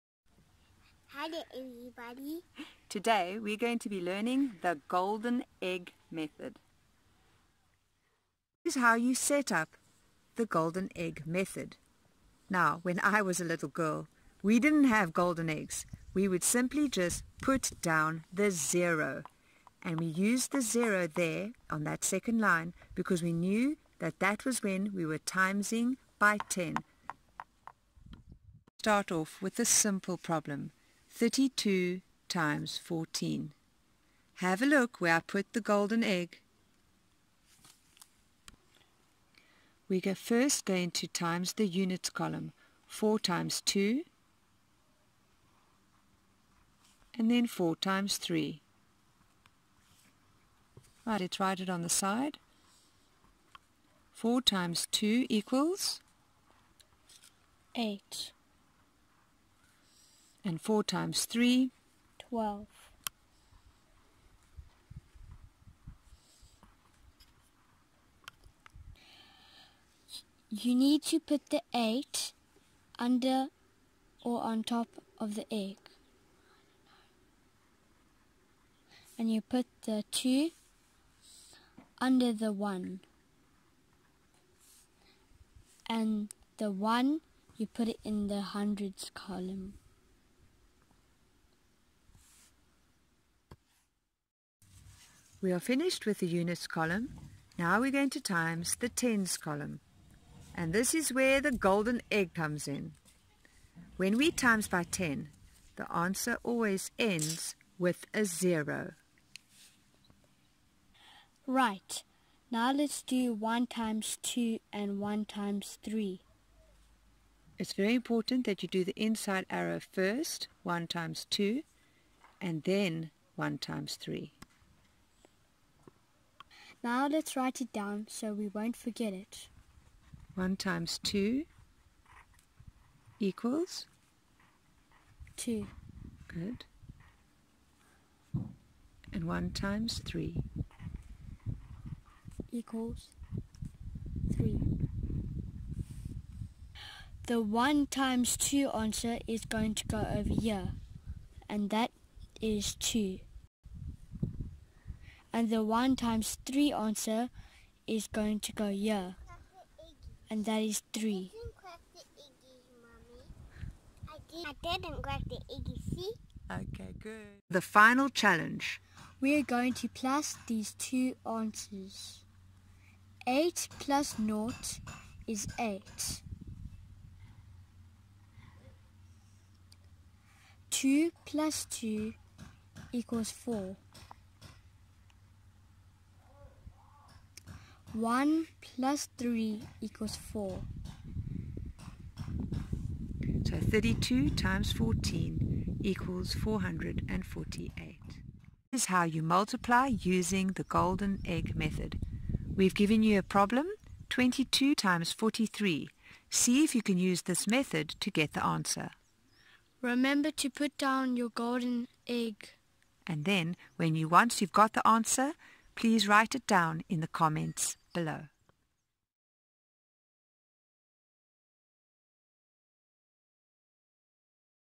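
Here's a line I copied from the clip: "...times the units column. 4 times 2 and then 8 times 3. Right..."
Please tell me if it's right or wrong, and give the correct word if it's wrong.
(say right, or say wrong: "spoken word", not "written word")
wrong: "4", not "8".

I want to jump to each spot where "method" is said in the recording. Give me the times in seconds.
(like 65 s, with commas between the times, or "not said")
6 s, 11 s, 201 s, 207 s.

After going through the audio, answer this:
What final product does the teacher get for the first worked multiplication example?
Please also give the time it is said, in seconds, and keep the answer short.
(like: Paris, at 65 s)
448, at 196 s.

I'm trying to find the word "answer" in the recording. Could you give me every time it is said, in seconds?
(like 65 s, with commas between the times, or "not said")
105 s, 148 s, 156 s, 171 s, 208 s, 214 s.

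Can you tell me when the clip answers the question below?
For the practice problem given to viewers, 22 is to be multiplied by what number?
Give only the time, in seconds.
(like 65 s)
205 s.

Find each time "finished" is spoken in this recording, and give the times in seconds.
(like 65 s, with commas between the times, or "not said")
95 s.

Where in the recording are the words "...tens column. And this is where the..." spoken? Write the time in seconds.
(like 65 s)
98 s.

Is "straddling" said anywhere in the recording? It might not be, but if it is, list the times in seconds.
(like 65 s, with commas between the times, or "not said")
not said.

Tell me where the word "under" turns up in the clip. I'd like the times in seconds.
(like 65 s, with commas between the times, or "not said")
72 s, 81 s.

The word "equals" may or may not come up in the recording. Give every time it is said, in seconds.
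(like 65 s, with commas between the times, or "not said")
55 s, 133 s, 142 s, 182 s, 189 s, 195 s.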